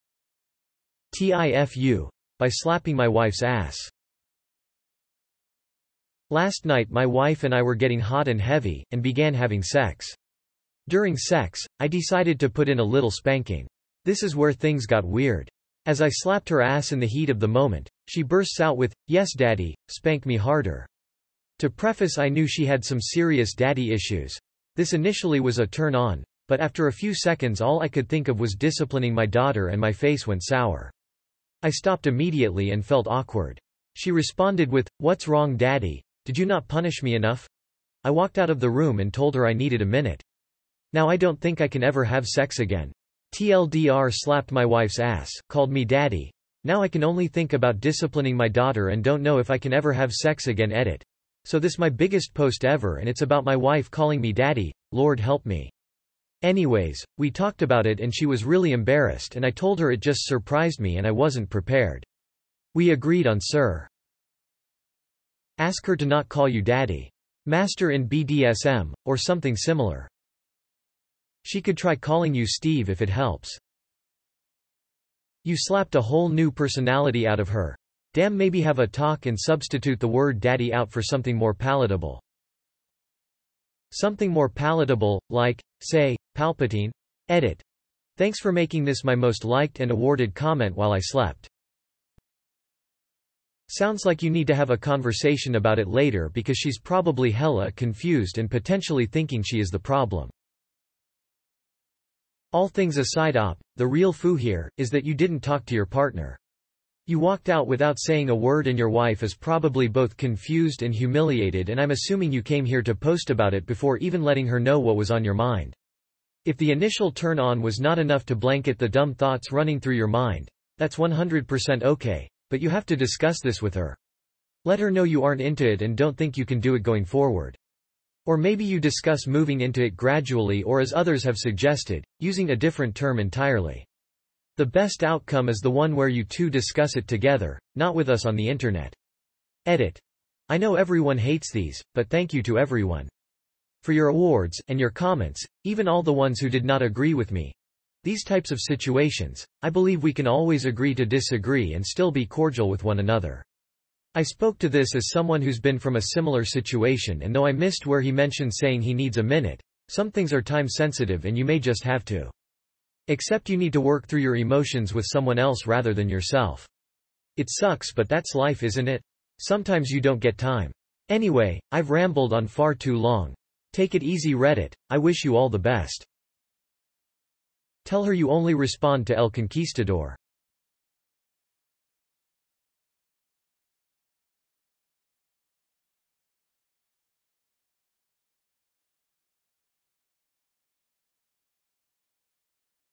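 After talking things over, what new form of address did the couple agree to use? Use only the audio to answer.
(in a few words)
Sir.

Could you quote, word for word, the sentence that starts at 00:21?
To preface I knew she had some serious daddy issues.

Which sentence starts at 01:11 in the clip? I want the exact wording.
She could try calling you Steve if it helps.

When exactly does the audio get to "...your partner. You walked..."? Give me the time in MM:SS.
01:45.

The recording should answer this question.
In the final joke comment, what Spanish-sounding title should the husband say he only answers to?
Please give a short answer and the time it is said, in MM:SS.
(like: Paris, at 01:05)
El Conquistador, at 02:59.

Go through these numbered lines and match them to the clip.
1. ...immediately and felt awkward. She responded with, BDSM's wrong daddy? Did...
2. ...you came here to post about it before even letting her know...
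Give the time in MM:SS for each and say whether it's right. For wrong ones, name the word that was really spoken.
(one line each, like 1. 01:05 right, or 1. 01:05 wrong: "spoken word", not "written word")
1. 00:32 wrong: "What", not "BDSM"
2. 01:52 right.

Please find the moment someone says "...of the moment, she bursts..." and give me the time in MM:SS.
00:17.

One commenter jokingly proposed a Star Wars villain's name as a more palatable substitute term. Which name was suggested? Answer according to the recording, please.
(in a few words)
Palpatine.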